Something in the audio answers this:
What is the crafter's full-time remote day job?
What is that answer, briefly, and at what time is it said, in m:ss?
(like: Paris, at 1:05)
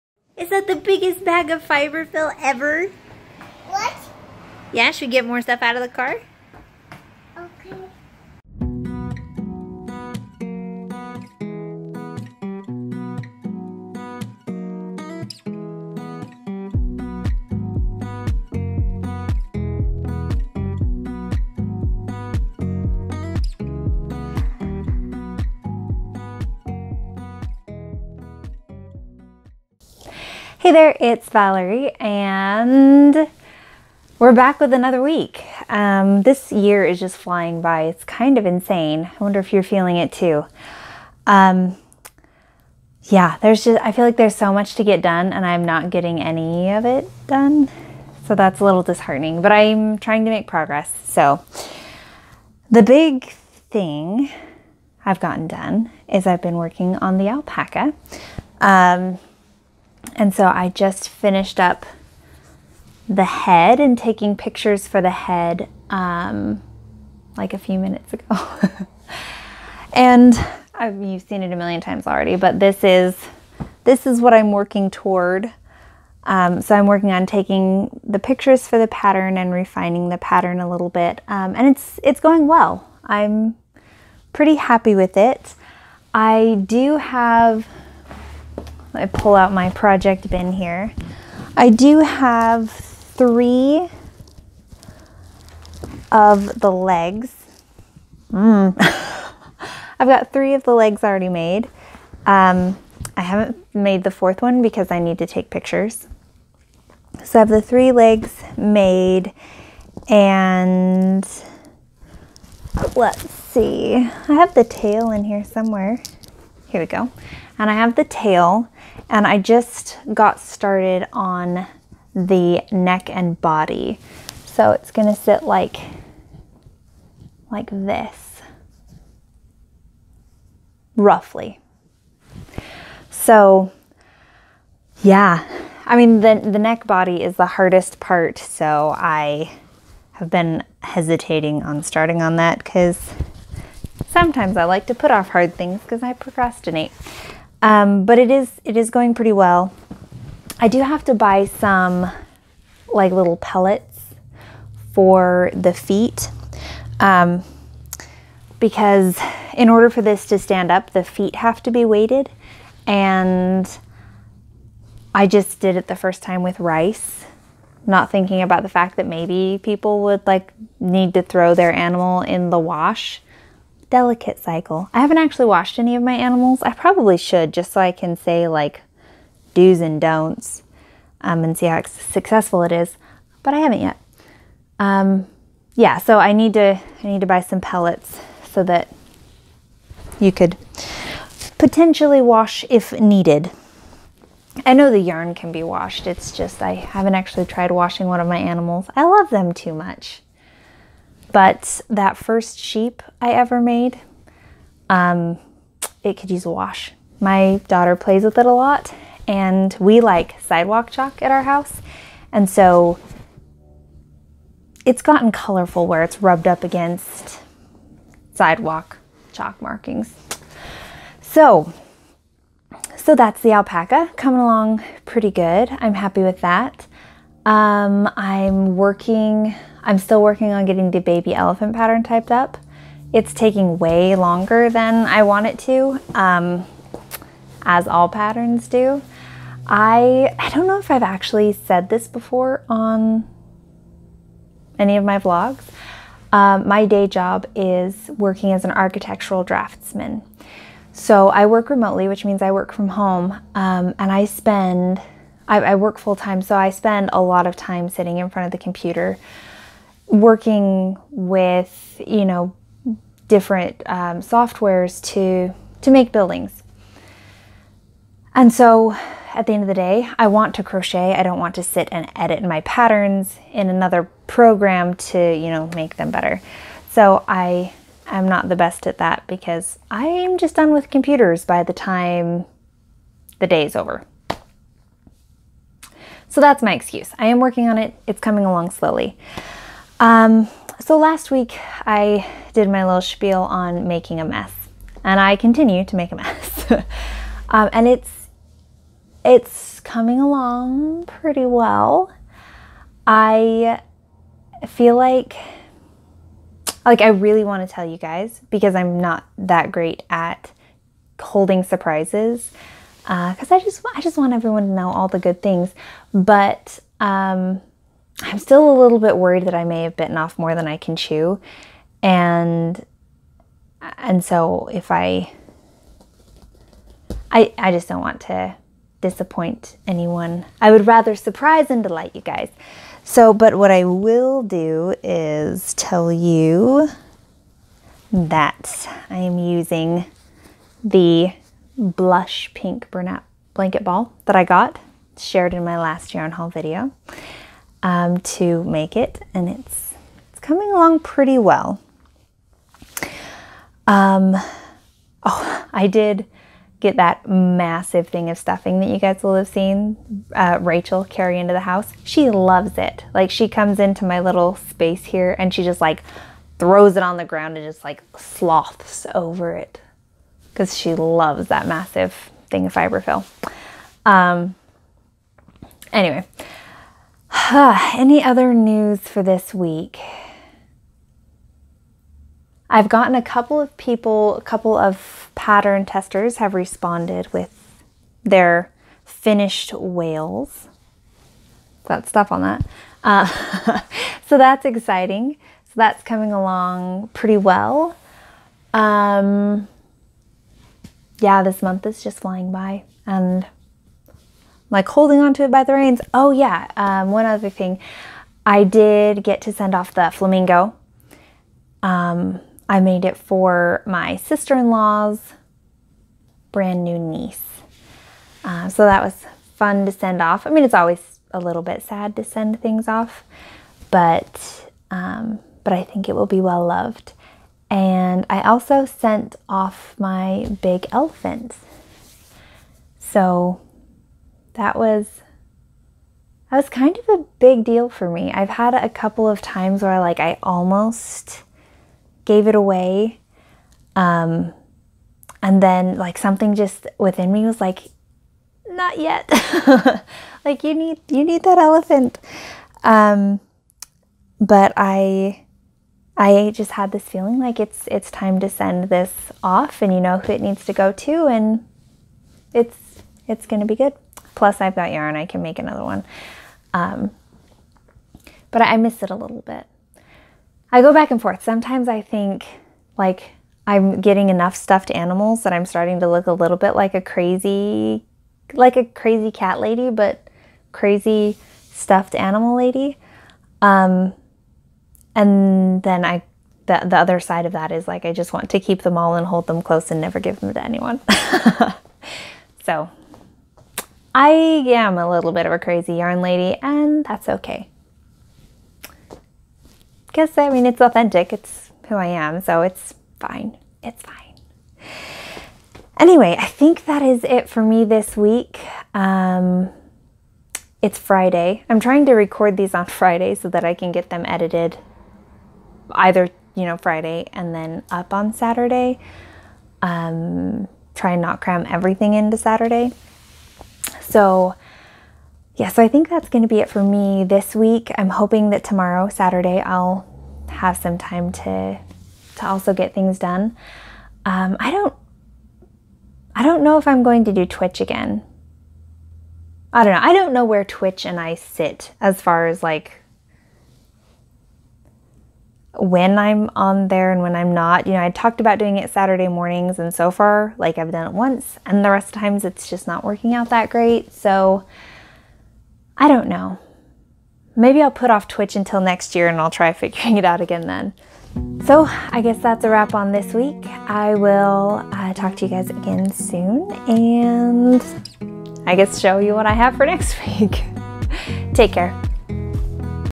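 architectural draftsman, at 4:08.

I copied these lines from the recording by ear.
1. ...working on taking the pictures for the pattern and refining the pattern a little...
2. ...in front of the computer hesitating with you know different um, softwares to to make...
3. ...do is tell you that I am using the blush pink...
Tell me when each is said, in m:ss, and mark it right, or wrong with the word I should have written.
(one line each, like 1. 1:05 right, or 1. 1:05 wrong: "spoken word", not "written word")
1. 1:16 right
2. 4:18 wrong: "working", not "hesitating"
3. 5:34 right.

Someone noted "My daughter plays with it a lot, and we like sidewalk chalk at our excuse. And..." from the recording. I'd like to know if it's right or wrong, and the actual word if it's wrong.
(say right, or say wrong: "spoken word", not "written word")
wrong: "house", not "excuse".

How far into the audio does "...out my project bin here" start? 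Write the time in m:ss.
1:29.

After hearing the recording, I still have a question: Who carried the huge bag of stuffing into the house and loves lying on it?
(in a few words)
Rachel.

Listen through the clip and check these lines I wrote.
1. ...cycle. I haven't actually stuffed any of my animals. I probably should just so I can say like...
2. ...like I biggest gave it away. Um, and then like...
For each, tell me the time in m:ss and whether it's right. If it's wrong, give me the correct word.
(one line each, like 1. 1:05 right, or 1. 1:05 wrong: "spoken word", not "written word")
1. 2:54 wrong: "washed", not "stuffed"
2. 7:19 wrong: "almost", not "biggest".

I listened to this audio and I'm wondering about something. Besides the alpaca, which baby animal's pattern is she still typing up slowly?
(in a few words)
baby elephant.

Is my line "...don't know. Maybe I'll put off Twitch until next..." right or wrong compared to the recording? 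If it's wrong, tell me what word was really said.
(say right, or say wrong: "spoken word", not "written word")
right.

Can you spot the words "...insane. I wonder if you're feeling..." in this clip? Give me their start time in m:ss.
0:38.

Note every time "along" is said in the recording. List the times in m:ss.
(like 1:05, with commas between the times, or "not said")
3:44, 4:48, 5:00, 5:50, 6:36.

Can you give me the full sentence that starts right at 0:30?
Hey there, it's Valerie, and we're back with another week.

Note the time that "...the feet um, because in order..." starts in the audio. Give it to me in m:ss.
2:35.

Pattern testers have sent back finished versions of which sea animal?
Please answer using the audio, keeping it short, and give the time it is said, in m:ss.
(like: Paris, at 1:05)
whales, at 6:29.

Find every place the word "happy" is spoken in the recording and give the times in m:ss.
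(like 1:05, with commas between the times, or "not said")
1:24, 3:45.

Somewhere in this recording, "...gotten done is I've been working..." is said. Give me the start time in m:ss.
0:55.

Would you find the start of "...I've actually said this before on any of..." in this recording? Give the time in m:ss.
4:00.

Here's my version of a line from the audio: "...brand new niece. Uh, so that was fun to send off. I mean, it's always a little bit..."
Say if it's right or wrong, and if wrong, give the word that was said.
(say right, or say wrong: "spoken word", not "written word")
right.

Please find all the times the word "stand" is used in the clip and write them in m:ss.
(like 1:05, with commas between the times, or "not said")
2:40.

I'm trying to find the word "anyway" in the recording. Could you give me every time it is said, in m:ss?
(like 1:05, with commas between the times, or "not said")
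6:15, 8:25.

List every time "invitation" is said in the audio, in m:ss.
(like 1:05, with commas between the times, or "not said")
not said.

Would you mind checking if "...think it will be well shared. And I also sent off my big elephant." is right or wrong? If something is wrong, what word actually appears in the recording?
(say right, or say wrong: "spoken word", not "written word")
wrong: "loved", not "shared".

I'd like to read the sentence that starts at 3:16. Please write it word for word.
It's just I haven't actually tried washing one of my animals.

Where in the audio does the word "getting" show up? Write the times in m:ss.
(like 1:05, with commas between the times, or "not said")
0:45, 3:50, 7:54.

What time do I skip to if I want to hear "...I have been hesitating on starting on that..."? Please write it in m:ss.
2:18.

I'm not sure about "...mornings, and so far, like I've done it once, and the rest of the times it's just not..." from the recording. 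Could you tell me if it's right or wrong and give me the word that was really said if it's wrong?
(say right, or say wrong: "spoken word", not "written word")
right.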